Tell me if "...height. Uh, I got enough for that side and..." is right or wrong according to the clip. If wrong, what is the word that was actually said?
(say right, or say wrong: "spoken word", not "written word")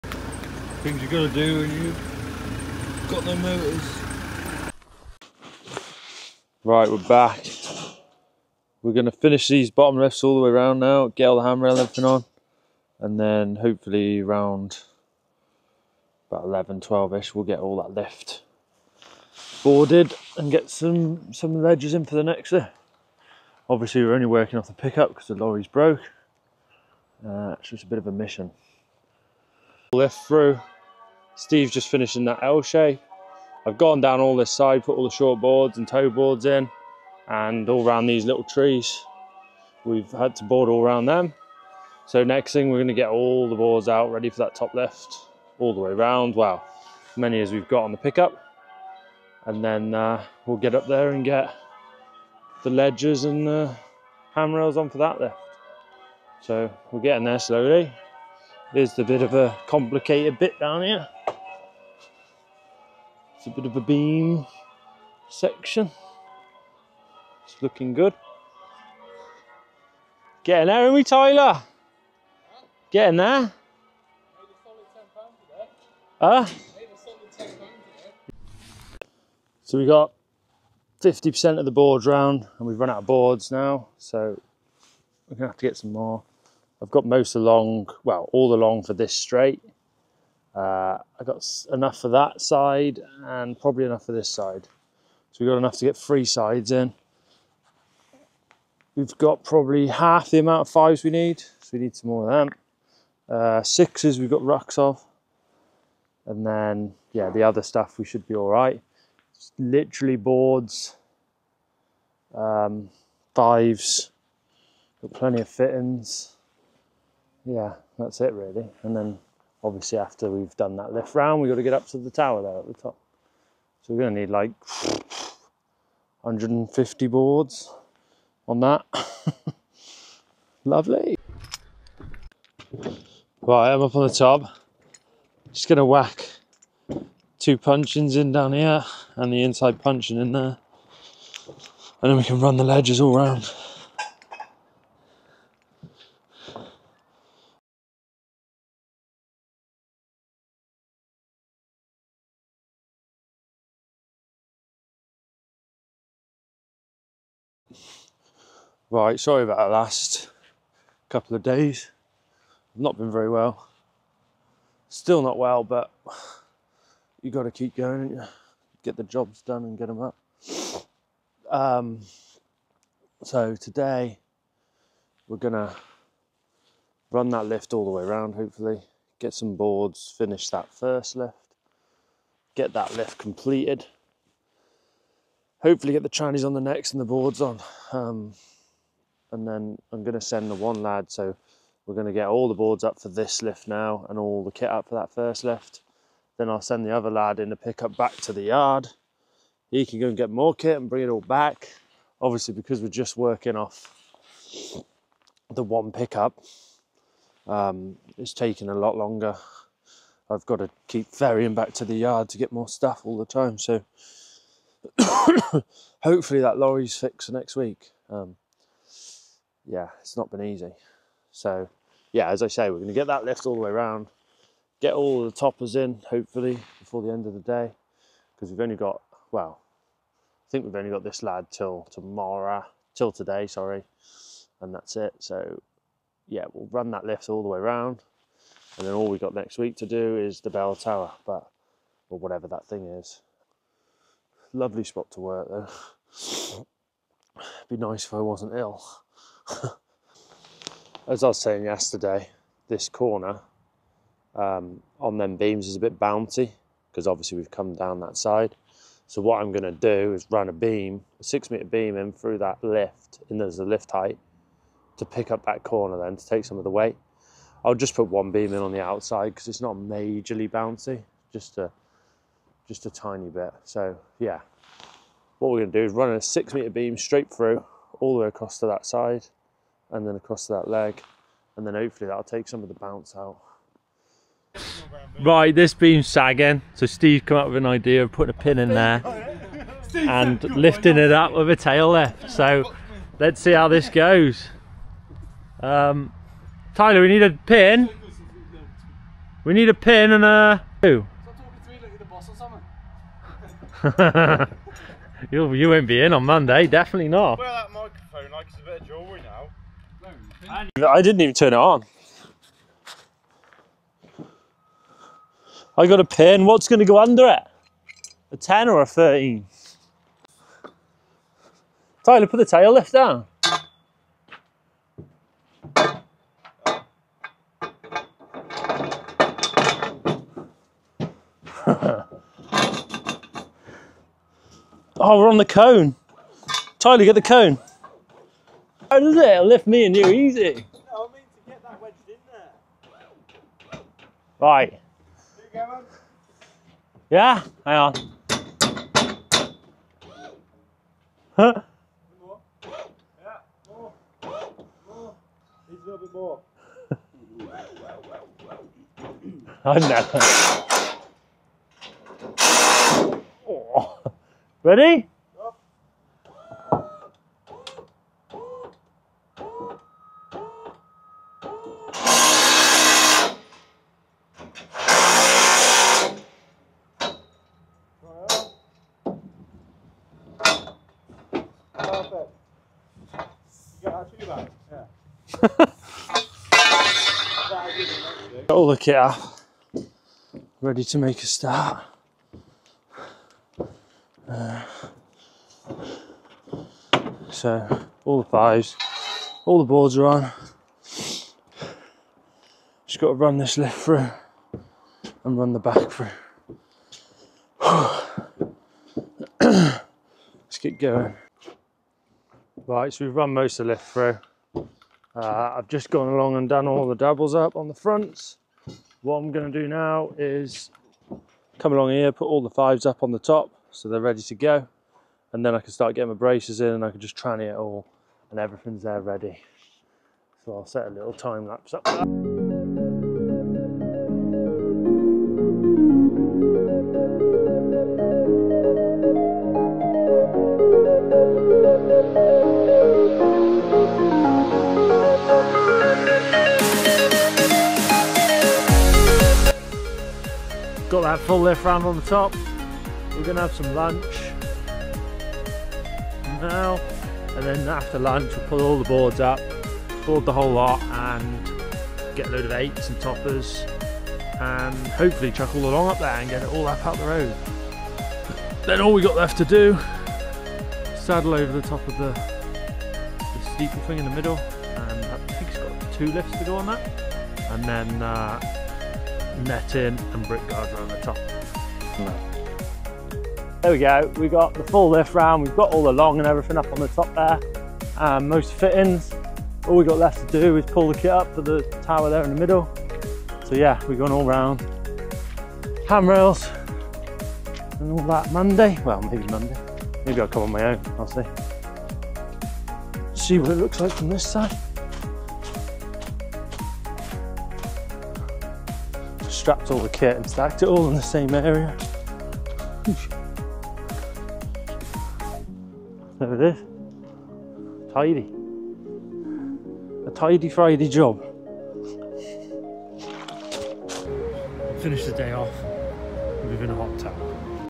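wrong: "straight", not "height".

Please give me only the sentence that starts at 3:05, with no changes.
Hopefully, get the trannies on the next and the boards on.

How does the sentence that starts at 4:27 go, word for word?
I'll just put one beam in on the outside because it's not majorly bouncy, just a just a tiny bit.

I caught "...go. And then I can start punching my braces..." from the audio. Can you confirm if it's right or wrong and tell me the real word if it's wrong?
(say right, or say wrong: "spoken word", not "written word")
wrong: "getting", not "punching".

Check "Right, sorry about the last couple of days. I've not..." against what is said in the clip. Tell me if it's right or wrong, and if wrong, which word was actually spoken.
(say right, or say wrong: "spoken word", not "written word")
right.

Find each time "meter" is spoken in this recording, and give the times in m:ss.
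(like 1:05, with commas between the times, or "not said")
4:21, 4:36.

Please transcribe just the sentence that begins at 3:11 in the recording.
So we're going to get all the boards up for this lift now and all the kit up for that first lift.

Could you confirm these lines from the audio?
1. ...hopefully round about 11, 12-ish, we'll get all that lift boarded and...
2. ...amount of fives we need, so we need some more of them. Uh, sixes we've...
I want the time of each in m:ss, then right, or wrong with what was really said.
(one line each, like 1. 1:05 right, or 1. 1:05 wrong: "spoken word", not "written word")
1. 0:13 right
2. 1:40 right.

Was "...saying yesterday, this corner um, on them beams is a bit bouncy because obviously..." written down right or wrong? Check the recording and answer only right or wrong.
right.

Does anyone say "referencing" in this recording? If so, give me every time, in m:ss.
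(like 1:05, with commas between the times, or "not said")
not said.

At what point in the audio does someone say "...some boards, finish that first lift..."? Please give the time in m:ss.
2:59.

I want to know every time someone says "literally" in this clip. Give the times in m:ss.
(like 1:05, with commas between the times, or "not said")
1:49.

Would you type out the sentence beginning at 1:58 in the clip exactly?
And then obviously after we've done that lift round, we've got to get up to the tower there at the top.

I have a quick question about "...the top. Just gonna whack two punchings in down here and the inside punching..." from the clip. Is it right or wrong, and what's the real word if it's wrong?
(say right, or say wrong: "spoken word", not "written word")
right.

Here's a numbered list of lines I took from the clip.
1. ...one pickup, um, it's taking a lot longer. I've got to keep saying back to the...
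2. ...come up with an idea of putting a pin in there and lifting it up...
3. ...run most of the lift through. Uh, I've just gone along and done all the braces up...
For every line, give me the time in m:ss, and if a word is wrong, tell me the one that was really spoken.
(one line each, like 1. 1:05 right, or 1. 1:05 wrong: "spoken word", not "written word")
1. 3:25 wrong: "ferrying", not "saying"
2. 4:47 right
3. 6:53 wrong: "doubles", not "braces".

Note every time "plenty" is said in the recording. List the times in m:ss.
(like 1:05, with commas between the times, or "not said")
1:55.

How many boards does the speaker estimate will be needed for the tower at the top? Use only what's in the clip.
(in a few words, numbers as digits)
150.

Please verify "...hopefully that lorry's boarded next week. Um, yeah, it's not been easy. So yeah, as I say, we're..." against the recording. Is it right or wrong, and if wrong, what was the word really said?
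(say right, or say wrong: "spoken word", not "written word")
wrong: "fixed", not "boarded".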